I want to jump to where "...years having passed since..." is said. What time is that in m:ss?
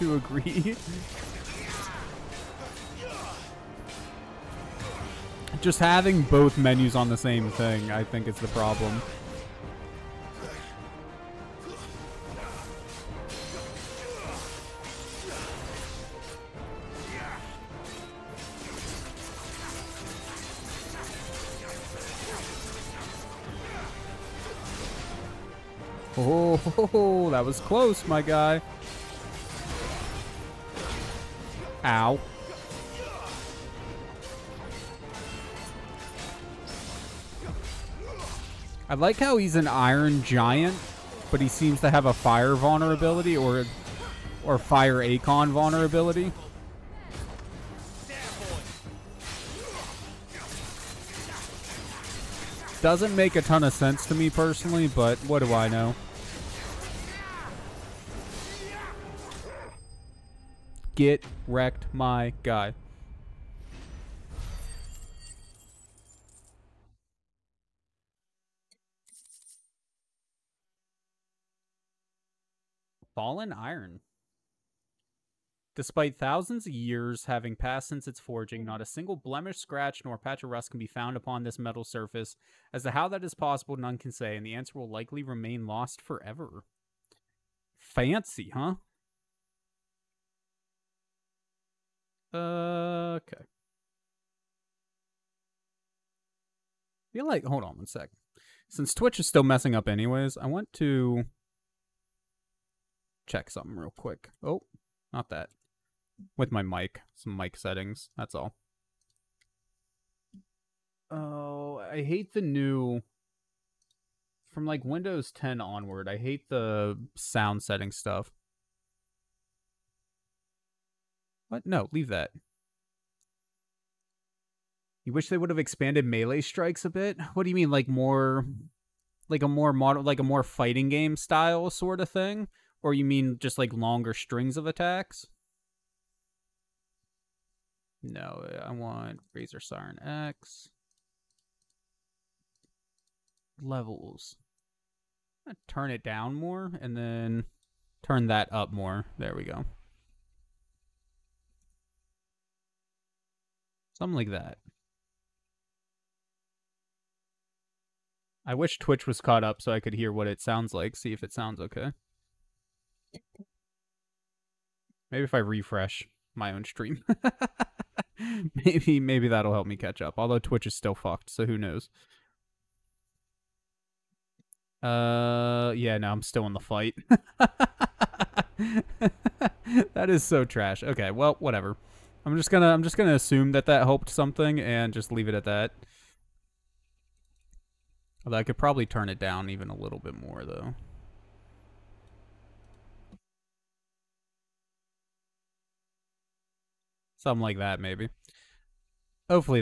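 1:16.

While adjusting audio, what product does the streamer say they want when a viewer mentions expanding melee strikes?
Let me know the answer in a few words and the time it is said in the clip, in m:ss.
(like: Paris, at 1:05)
Razor Siren X, at 2:19.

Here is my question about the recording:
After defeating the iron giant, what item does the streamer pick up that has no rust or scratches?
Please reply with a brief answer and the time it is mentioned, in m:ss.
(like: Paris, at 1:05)
Fallen iron, at 1:13.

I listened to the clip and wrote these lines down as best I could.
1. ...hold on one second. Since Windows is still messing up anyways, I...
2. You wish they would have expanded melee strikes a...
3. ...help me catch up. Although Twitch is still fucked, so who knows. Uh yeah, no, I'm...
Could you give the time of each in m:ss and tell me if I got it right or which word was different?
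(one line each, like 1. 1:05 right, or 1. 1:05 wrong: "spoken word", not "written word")
1. 1:37 wrong: "Twitch", not "Windows"
2. 2:05 right
3. 2:49 right.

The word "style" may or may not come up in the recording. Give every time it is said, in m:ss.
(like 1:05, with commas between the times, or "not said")
2:11.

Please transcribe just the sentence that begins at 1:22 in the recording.
As to how that is possible, none can say, and the answer will likely remain lost forever.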